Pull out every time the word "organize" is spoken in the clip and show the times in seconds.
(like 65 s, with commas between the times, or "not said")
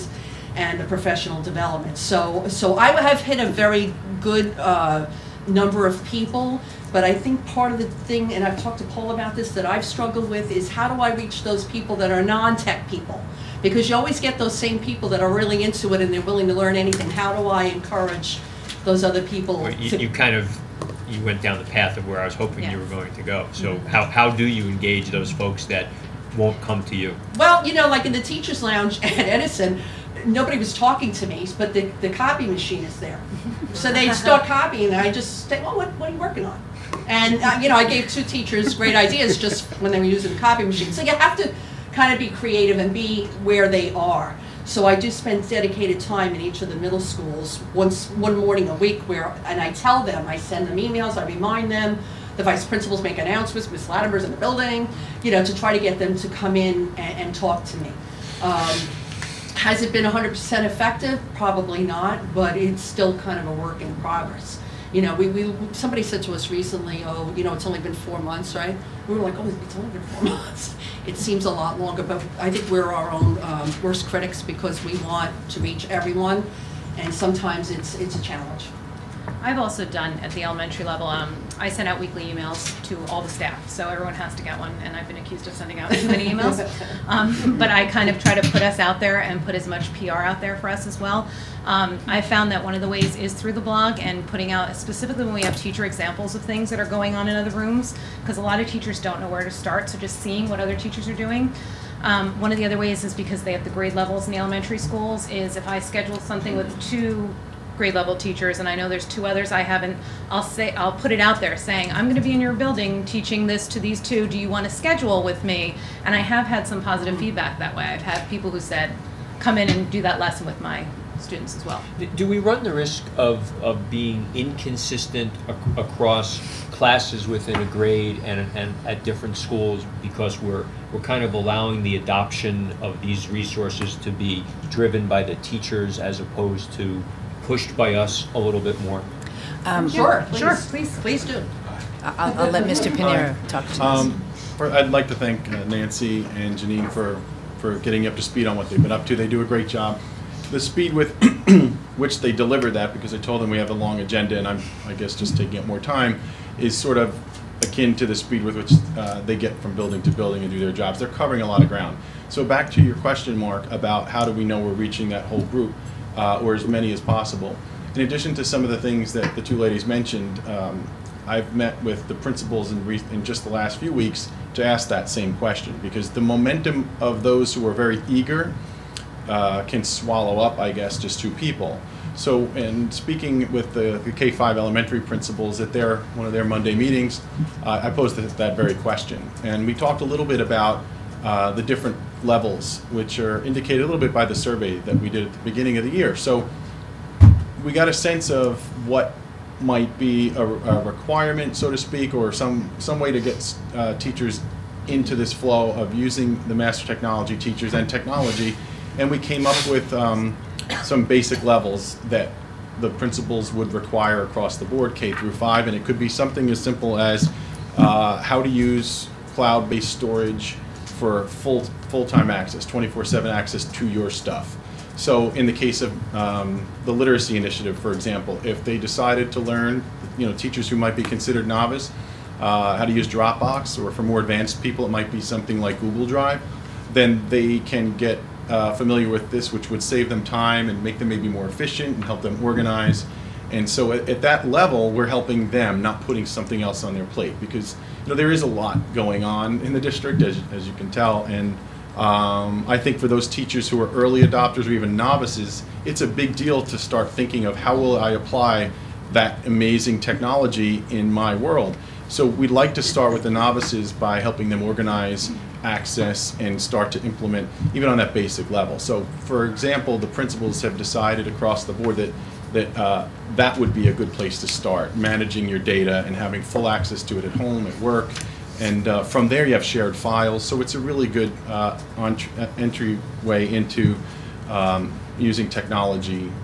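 242 s, 264 s.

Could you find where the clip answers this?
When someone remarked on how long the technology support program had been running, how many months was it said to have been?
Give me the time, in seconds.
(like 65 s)
67 s.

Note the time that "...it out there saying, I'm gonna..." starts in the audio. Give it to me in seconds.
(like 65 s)
111 s.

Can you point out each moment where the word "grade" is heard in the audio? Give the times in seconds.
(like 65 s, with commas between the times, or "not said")
103 s, 107 s, 127 s.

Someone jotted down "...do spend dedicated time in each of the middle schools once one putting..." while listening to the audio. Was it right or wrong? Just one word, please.
wrong.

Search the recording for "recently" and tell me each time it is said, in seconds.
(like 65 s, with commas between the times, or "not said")
66 s.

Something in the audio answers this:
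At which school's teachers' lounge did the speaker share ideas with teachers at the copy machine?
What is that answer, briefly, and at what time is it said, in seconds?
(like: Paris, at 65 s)
Edison, at 29 s.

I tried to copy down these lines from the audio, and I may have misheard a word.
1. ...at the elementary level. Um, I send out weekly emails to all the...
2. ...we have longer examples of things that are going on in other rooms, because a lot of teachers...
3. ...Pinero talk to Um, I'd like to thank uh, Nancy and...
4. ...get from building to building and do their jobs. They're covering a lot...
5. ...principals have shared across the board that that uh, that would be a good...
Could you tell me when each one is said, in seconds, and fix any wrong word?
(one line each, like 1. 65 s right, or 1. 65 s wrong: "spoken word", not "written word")
1. 80 s right
2. 95 s wrong: "teacher", not "longer"
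3. 142 s right
4. 159 s right
5. 270 s wrong: "decided", not "shared".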